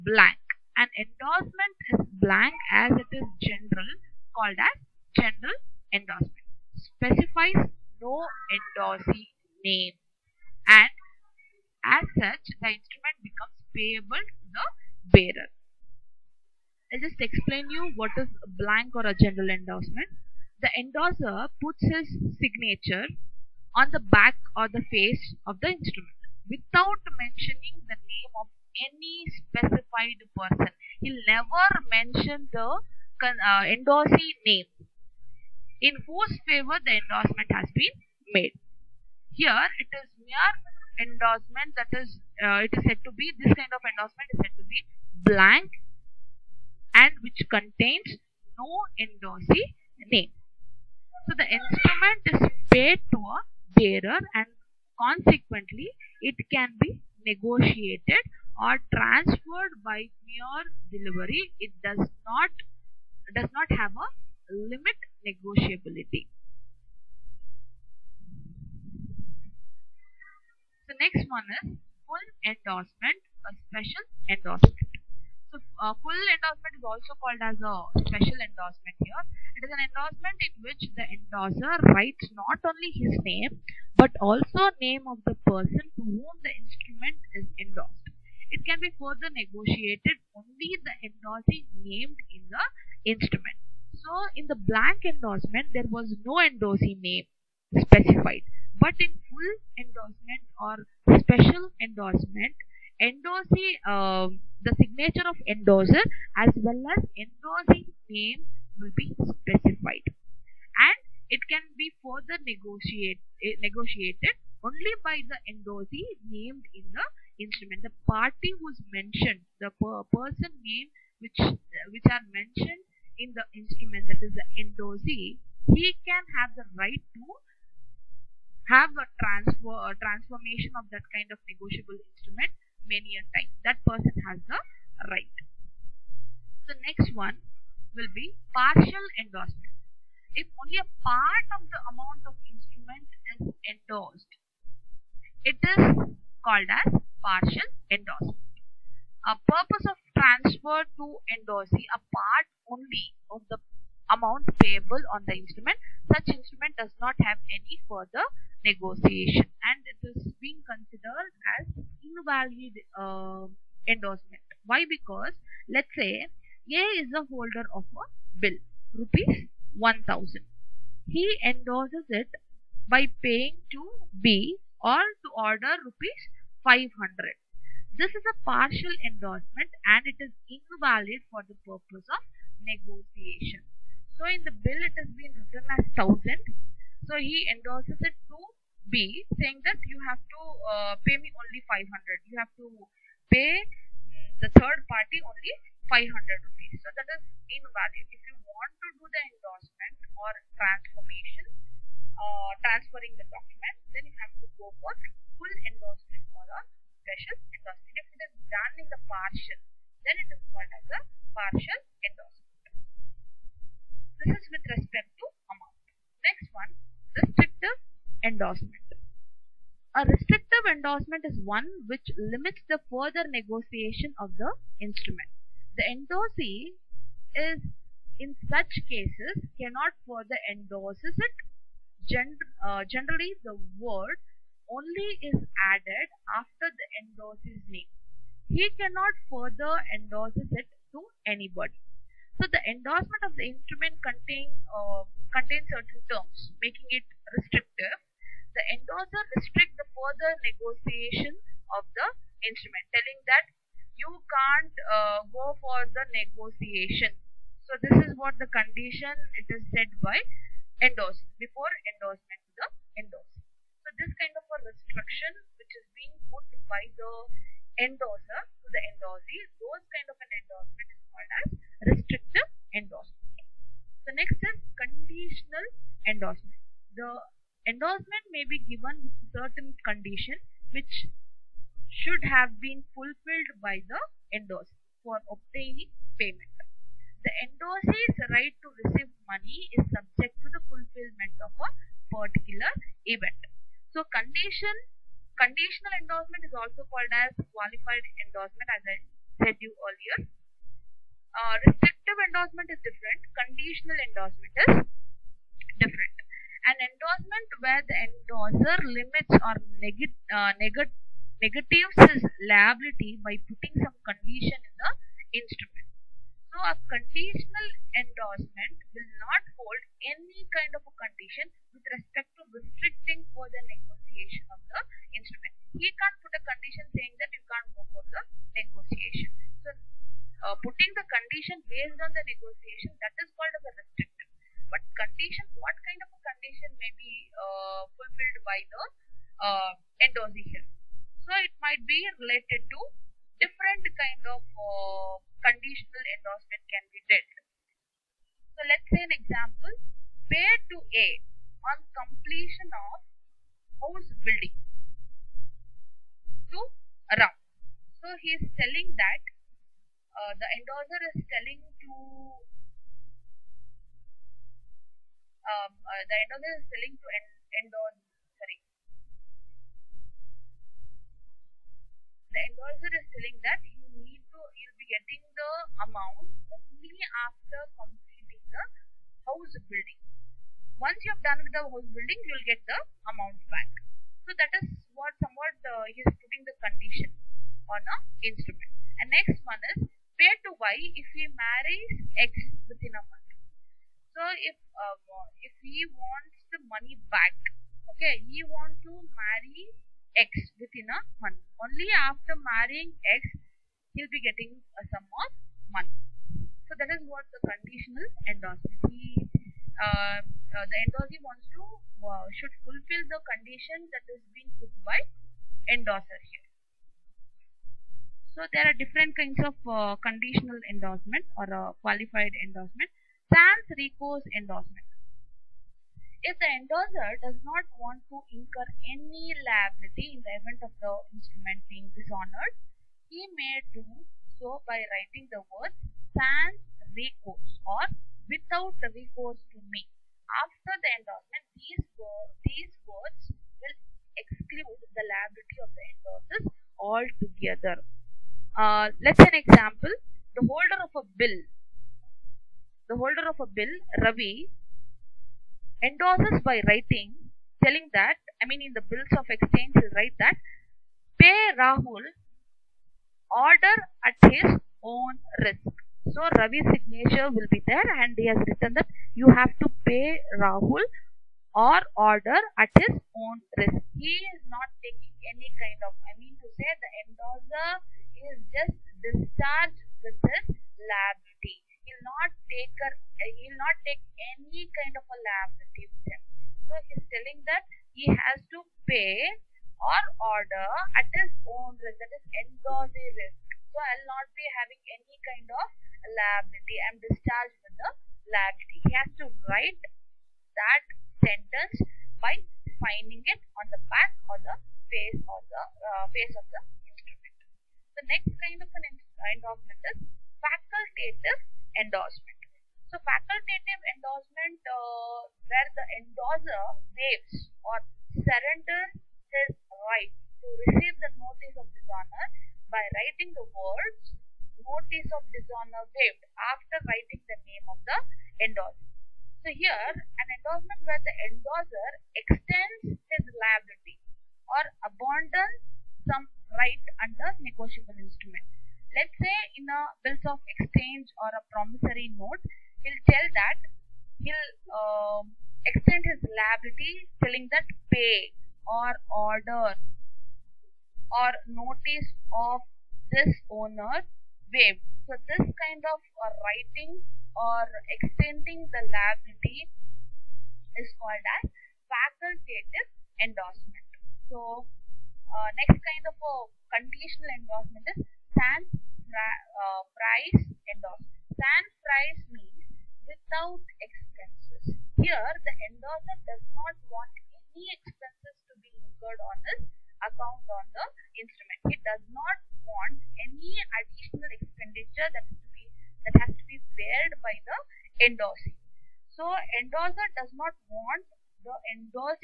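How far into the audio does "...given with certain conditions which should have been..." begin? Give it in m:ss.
4:38.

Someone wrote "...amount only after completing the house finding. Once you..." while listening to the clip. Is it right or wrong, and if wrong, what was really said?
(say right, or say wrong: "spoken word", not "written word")
wrong: "building", not "finding".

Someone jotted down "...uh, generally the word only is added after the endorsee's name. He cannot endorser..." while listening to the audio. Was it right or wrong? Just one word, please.
wrong.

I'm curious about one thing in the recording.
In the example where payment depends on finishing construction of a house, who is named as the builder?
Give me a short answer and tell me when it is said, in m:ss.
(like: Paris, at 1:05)
Ram, at 5:57.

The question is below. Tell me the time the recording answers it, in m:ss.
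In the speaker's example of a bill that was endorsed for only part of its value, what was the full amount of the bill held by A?
2:48.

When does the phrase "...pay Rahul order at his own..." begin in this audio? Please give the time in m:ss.
7:41.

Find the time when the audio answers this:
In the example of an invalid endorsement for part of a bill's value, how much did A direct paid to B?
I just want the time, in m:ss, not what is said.
2:55.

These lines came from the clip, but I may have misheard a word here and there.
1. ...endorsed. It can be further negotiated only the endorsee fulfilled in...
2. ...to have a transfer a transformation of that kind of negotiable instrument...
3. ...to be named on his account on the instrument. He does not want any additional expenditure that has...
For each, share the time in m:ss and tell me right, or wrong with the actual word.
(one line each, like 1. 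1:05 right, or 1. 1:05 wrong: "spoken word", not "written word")
1. 1:27 wrong: "named", not "fulfilled"
2. 2:07 right
3. 9:38 wrong: "incurred", not "named".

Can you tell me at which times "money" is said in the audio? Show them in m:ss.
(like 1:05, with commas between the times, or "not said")
4:49, 6:36, 6:45.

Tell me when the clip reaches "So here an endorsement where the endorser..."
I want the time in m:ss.
8:49.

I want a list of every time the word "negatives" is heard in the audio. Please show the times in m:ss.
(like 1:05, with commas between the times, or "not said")
5:11.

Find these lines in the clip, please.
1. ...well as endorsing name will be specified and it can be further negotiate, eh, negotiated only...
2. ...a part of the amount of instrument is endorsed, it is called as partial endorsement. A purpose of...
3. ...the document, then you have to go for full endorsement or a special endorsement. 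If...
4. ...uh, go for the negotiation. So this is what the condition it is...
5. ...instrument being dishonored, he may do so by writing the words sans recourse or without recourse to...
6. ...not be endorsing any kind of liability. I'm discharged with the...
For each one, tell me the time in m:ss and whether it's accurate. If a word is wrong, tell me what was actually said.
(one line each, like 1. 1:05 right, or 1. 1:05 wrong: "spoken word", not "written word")
1. 1:46 right
2. 2:20 right
3. 3:23 right
4. 4:14 right
5. 7:11 right
6. 8:14 wrong: "having", not "endorsing".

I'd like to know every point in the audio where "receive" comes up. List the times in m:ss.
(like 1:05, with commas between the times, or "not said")
4:48, 8:40.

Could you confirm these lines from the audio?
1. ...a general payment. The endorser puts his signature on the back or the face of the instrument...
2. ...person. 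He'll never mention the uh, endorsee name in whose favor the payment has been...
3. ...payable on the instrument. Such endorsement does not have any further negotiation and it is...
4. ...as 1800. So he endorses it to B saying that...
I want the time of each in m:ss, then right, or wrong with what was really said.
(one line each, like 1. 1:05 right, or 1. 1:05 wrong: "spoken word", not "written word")
1. 0:19 wrong: "endorsement", not "payment"
2. 0:30 wrong: "endorsement", not "payment"
3. 2:34 wrong: "instrument", not "endorsement"
4. 3:05 wrong: "1000", not "1800".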